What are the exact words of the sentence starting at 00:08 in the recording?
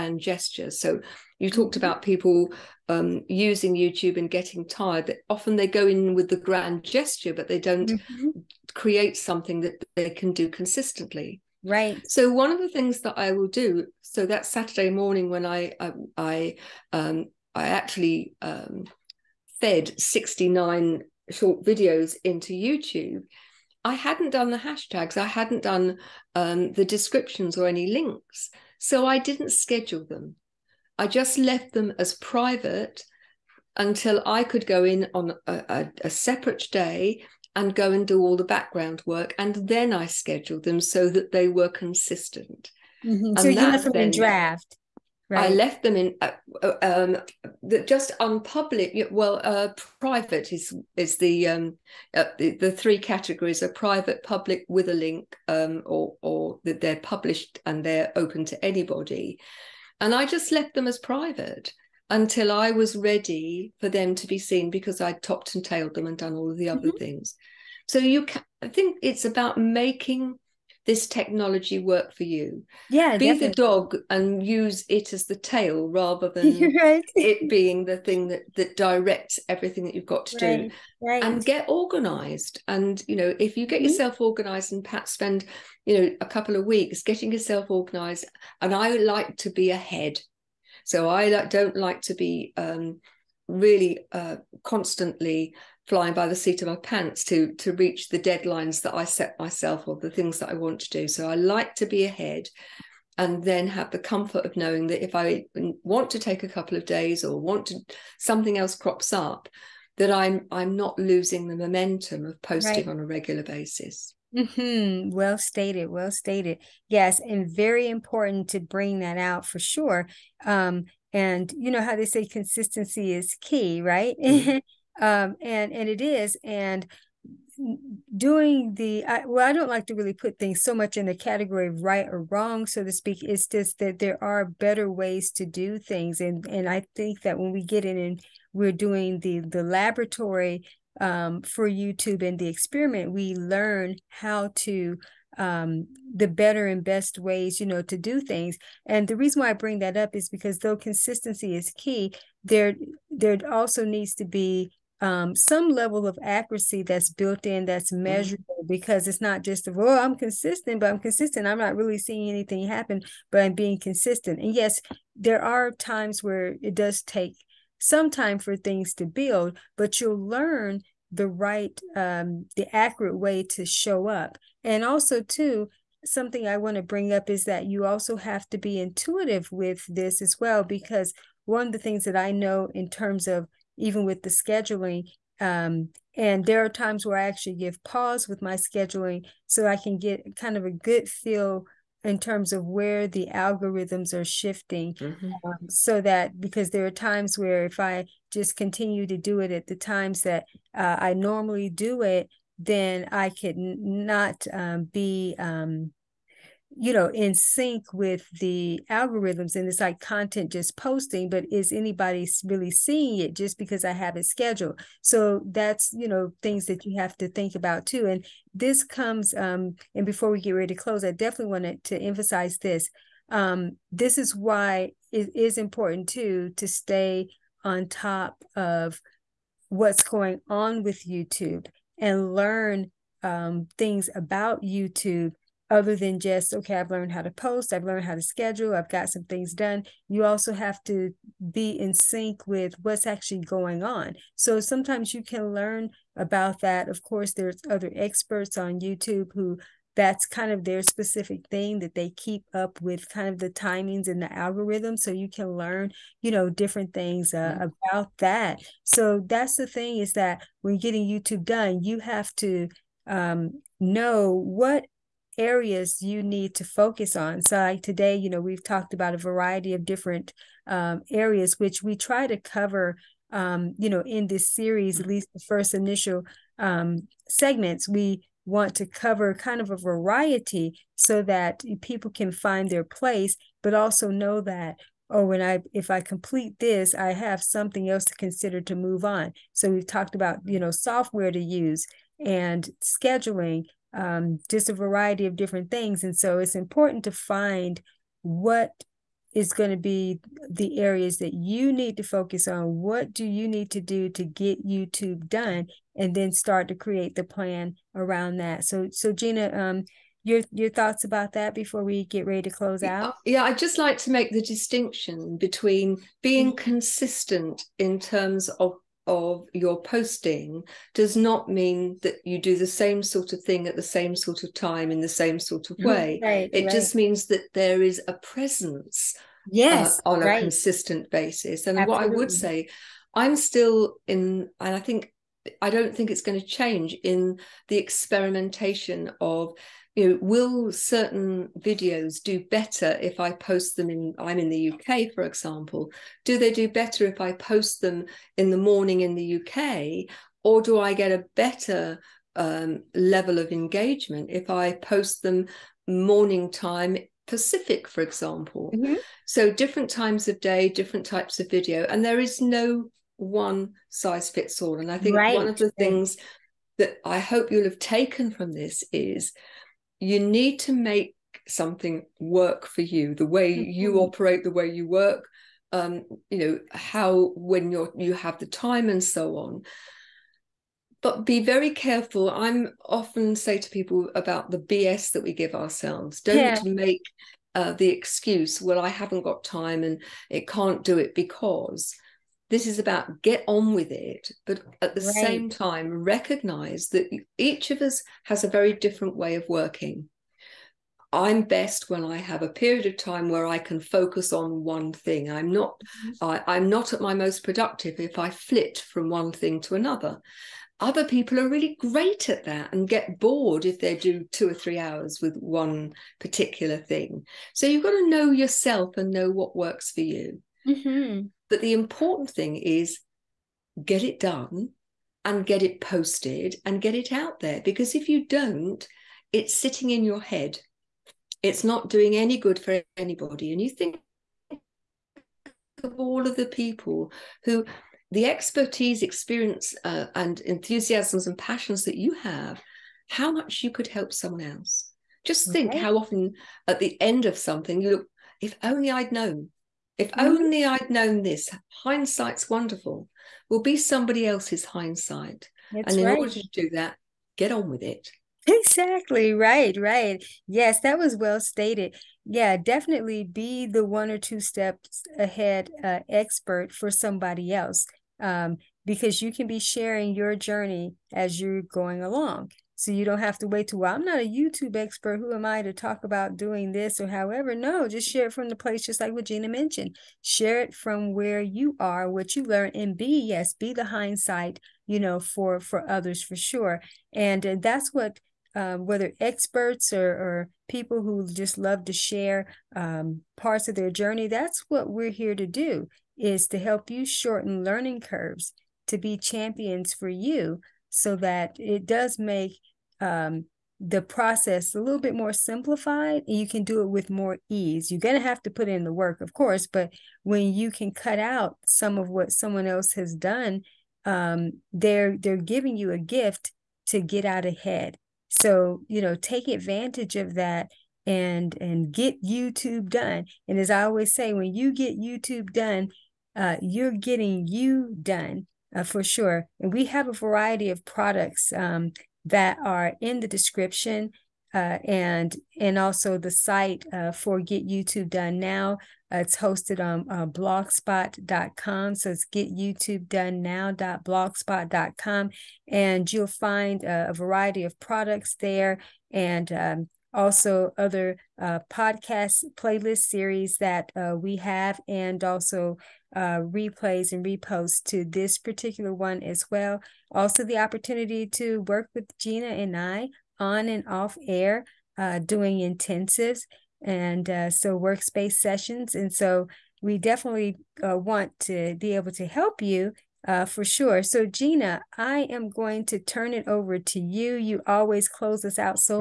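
create something that they can do consistently Right.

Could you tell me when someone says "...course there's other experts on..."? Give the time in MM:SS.
04:07.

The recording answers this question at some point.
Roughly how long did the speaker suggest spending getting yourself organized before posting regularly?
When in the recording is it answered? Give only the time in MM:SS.
01:26.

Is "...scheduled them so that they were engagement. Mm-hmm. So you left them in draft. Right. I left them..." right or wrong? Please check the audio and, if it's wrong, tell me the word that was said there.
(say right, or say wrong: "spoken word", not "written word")
wrong: "consistent", not "engagement".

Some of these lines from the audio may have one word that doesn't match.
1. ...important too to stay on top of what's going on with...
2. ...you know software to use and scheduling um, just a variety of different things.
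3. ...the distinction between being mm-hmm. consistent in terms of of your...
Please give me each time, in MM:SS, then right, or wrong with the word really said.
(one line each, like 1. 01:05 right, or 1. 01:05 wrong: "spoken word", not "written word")
1. 03:45 right
2. 04:50 right
3. 05:14 right.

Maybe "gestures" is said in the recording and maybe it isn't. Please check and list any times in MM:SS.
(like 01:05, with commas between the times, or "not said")
00:00, 00:06.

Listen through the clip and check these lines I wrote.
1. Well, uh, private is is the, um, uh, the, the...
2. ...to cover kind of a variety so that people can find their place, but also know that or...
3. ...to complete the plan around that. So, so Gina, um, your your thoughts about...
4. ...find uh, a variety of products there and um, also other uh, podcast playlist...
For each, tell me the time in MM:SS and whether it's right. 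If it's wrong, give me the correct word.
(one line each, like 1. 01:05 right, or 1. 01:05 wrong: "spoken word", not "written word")
1. 00:49 right
2. 04:38 right
3. 05:06 wrong: "create", not "complete"
4. 09:06 right.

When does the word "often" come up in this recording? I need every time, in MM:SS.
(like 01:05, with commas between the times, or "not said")
00:05, 06:22, 07:25.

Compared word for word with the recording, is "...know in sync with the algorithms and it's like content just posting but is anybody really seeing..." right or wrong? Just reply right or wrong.
right.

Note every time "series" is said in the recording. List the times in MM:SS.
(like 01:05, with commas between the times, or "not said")
04:34, 09:12.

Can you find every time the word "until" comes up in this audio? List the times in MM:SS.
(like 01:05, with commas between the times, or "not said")
00:33, 01:02.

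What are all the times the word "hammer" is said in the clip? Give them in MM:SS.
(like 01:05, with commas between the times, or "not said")
not said.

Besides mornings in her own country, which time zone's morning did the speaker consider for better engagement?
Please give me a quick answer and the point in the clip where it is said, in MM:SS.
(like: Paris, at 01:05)
Pacific, at 05:57.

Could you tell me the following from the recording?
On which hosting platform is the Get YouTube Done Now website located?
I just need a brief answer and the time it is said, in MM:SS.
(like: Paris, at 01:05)
blogspot.com, at 09:00.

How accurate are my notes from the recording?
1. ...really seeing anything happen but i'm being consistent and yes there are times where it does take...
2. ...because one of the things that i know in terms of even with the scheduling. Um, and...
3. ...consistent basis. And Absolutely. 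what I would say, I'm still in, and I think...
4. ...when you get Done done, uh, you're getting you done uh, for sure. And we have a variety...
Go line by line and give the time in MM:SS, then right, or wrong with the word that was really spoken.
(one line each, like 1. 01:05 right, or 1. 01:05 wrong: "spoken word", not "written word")
1. 02:41 right
2. 03:00 right
3. 05:30 right
4. 08:44 wrong: "YouTube", not "Done".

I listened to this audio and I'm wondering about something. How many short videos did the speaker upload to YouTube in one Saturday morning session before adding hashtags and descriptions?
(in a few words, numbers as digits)
69.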